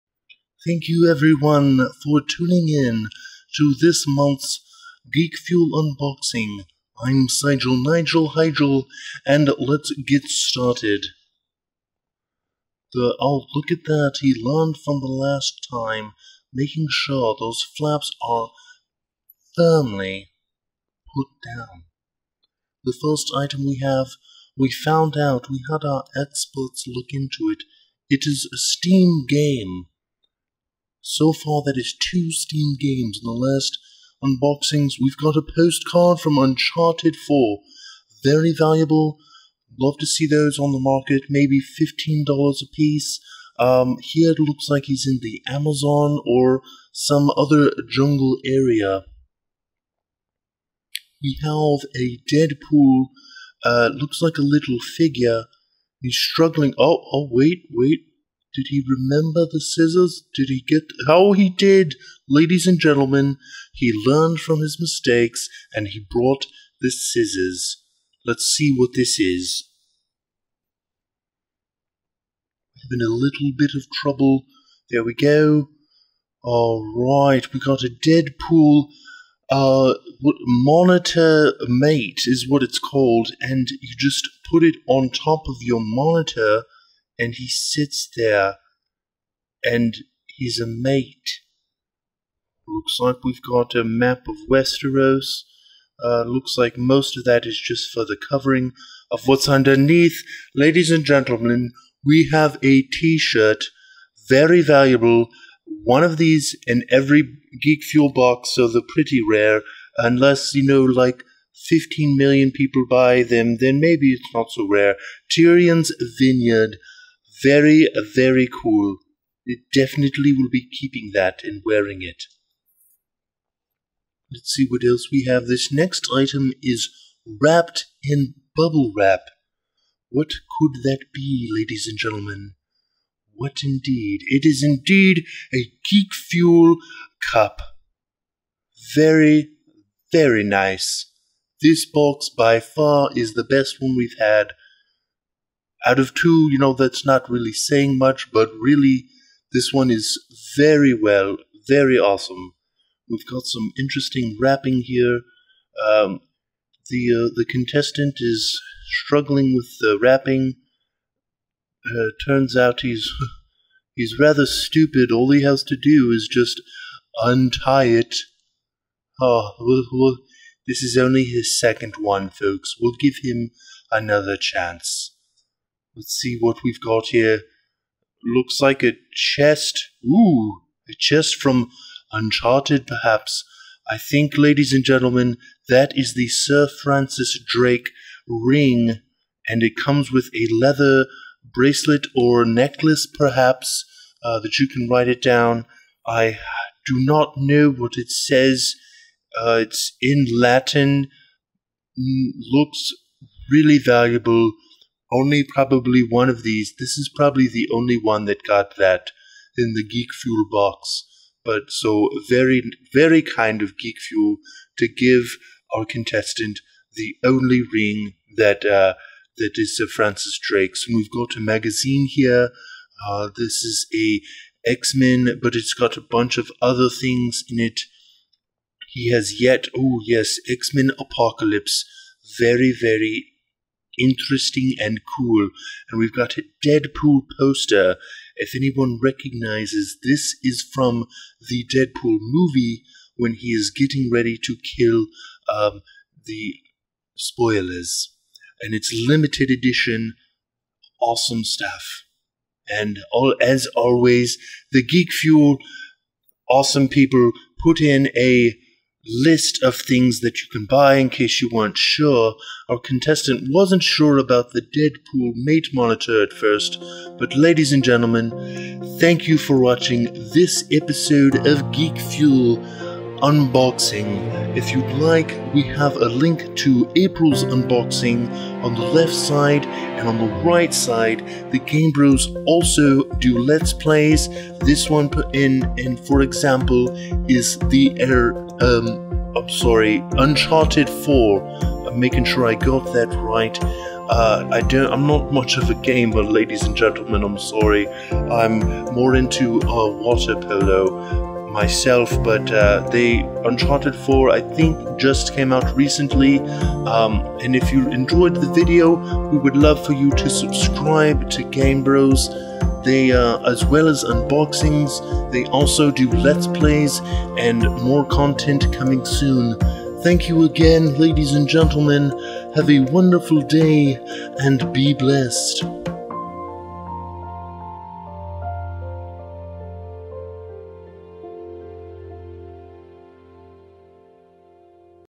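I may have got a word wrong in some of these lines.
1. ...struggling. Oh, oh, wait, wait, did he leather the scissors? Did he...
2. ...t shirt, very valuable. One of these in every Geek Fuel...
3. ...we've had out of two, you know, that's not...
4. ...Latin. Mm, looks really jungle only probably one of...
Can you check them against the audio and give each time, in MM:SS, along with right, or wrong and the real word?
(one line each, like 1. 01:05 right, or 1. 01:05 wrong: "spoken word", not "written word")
1. 00:56 wrong: "remember", not "leather"
2. 01:42 right
3. 02:23 right
4. 03:20 wrong: "valuable", not "jungle".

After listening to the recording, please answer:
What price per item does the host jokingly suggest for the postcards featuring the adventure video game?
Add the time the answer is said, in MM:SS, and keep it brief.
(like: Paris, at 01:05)
$15, at 00:41.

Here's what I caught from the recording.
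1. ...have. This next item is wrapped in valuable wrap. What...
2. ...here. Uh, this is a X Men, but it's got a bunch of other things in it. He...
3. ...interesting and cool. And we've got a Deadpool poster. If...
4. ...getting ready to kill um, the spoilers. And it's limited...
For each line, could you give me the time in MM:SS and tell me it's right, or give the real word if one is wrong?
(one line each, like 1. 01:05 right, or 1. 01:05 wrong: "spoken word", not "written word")
1. 02:05 wrong: "bubble", not "valuable"
2. 03:42 right
3. 03:54 right
4. 04:03 right.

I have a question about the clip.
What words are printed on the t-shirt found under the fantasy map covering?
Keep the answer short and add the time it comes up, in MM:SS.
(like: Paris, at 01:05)
Tyrion's Vineyard, at 01:55.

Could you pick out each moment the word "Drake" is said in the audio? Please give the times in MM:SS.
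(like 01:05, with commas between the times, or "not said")
03:07, 03:40.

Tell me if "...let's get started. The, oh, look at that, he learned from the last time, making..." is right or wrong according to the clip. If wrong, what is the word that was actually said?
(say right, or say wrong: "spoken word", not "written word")
right.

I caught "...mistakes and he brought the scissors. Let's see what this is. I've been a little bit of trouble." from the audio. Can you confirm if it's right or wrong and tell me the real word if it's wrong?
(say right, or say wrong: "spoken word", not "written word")
right.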